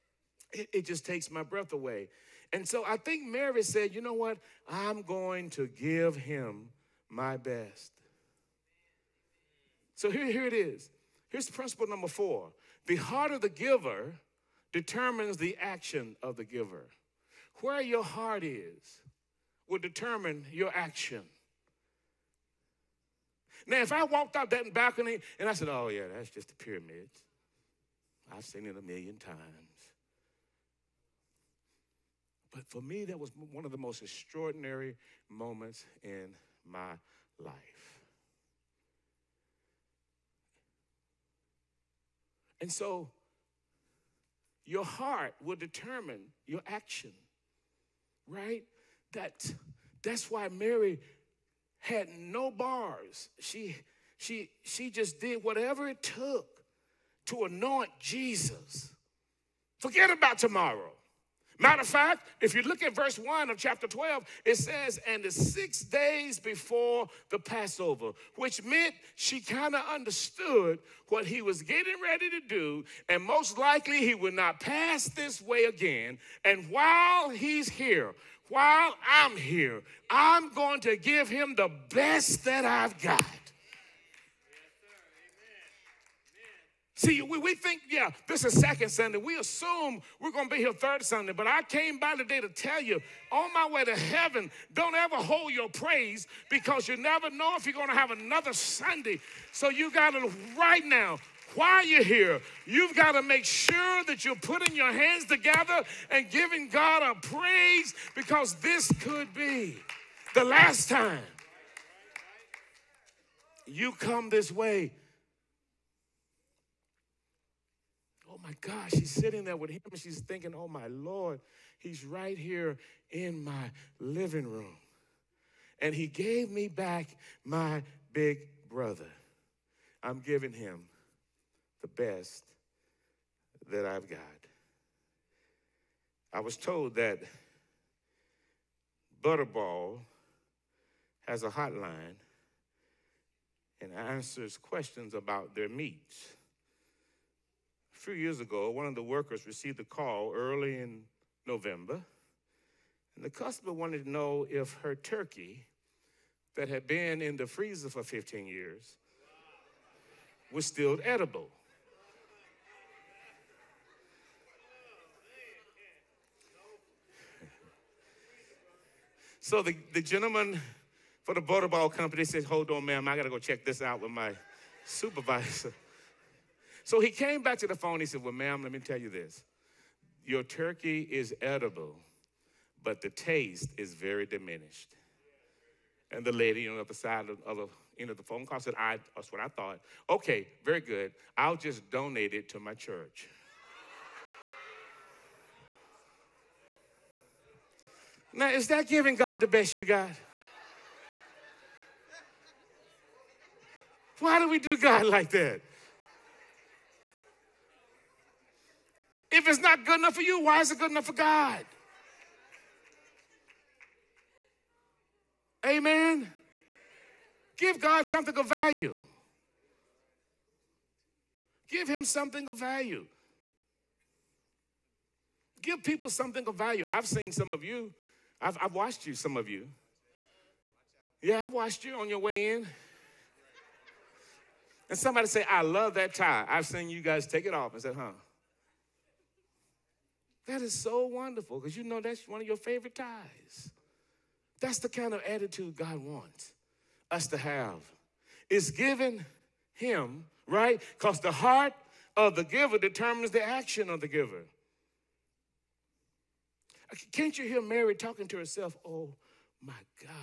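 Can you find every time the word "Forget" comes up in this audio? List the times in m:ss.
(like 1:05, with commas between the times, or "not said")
0:59.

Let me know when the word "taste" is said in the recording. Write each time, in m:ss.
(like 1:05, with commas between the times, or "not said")
3:03.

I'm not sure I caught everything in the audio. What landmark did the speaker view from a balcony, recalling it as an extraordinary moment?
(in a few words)
The pyramids.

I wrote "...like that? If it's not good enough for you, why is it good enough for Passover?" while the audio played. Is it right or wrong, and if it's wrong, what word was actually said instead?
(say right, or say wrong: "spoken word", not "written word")
wrong: "God", not "Passover".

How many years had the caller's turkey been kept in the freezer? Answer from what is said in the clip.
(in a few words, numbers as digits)
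15.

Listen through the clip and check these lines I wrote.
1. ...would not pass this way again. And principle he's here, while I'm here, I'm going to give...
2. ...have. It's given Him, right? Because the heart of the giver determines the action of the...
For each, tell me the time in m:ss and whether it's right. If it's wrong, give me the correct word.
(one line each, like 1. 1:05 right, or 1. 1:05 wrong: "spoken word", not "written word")
1. 1:14 wrong: "while", not "principle"
2. 4:07 right.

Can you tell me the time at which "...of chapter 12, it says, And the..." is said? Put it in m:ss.
1:03.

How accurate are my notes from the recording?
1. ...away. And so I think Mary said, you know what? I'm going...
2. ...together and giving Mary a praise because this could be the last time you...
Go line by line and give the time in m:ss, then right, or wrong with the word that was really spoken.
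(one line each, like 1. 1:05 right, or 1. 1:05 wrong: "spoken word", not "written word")
1. 0:01 right
2. 1:45 wrong: "God", not "Mary".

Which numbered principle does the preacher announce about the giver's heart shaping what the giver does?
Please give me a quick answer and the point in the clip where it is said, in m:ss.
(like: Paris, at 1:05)
4, at 0:11.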